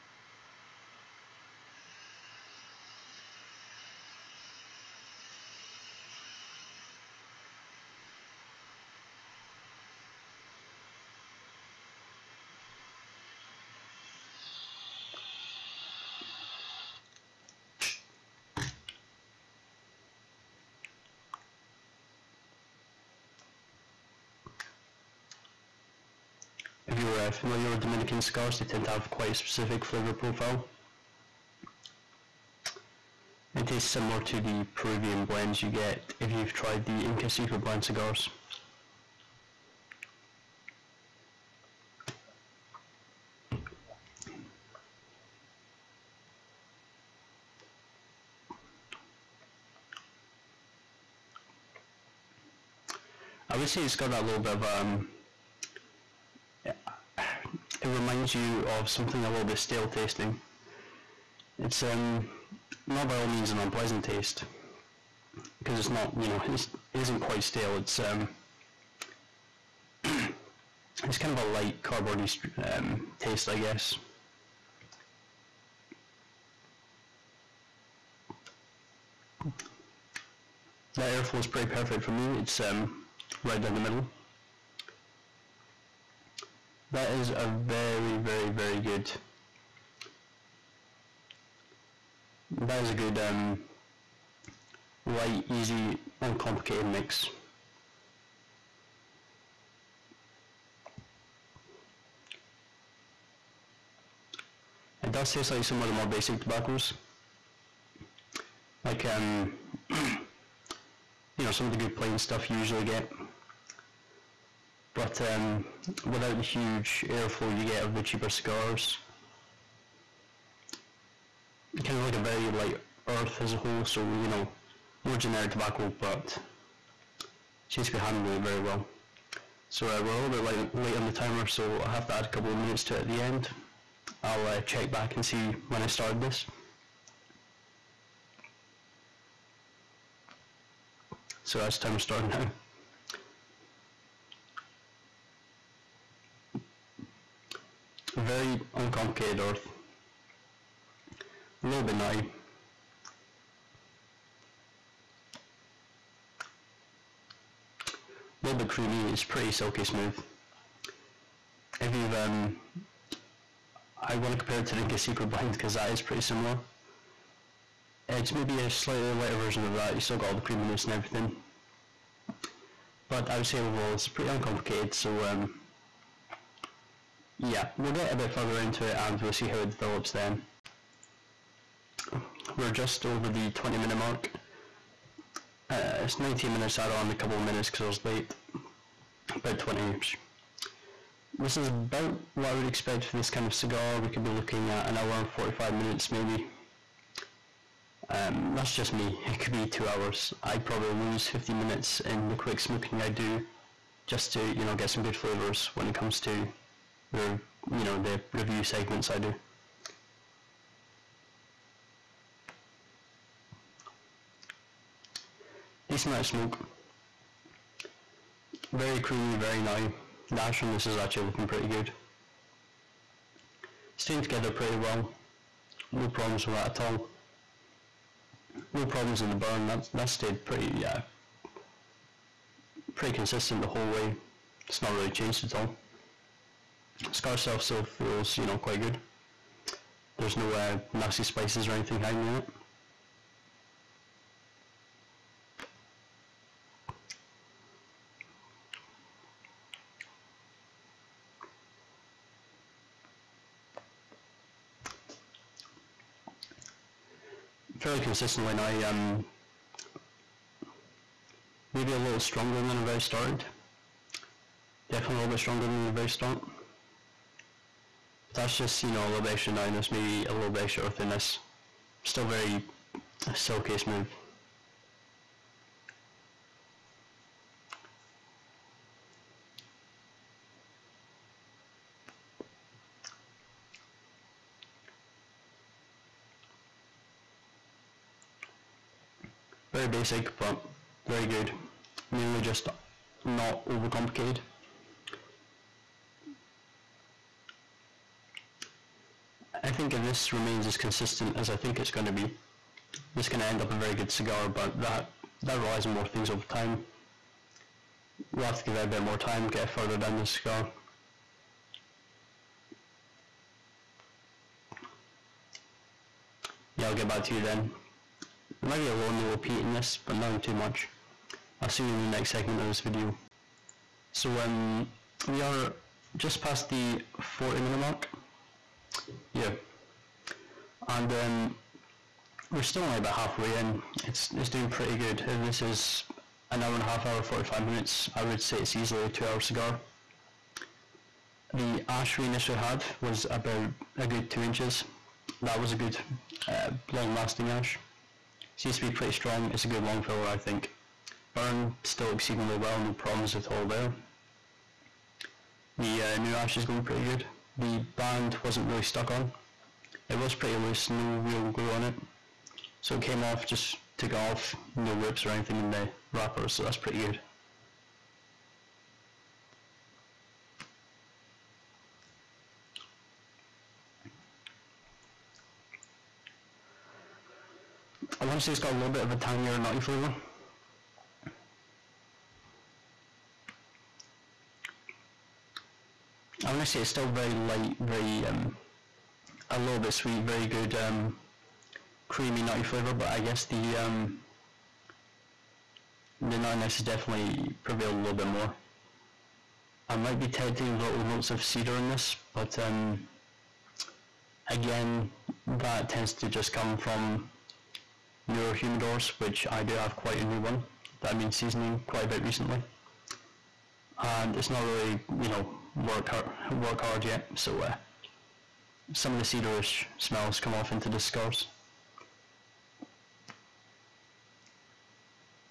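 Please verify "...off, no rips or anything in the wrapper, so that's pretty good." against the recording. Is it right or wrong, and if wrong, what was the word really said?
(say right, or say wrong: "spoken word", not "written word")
right.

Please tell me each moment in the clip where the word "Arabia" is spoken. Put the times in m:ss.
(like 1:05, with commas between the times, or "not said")
not said.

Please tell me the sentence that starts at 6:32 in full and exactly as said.
But I guess the um, the nuttiness has definitely prevailed a little bit more.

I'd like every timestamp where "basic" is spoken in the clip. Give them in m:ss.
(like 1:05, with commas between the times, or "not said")
1:46, 4:49.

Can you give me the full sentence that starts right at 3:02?
We're just over the 20 minute mark.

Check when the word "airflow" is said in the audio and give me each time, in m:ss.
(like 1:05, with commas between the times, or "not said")
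1:21, 1:57.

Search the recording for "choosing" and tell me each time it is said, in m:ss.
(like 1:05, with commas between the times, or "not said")
not said.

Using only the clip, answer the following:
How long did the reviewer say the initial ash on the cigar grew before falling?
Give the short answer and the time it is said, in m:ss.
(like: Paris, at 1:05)
2 inches, at 5:44.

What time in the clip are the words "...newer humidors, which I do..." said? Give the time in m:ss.
6:48.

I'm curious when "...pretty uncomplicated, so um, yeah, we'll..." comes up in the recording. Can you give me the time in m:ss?
2:54.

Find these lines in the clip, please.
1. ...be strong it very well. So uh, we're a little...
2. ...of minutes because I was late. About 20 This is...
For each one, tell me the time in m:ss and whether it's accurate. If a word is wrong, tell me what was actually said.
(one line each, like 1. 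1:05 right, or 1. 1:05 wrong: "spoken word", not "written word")
1. 2:07 wrong: "handling", not "strong"
2. 3:07 right.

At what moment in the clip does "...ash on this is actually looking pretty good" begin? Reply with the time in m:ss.
3:40.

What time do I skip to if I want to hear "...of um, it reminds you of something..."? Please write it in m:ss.
0:54.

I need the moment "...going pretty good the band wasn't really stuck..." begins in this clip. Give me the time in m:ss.
5:56.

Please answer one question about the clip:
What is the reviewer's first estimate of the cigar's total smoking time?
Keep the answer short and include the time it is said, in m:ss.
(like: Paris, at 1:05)
1 hour 45 minutes, at 3:14.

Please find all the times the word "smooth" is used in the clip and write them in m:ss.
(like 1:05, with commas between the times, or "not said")
2:39, 4:33.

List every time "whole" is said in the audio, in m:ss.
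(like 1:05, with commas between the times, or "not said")
2:03, 3:53.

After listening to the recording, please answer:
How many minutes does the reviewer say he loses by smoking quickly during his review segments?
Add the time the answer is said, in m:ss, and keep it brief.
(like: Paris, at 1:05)
50, at 3:21.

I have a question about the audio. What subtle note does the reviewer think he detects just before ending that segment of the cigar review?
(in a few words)
peat.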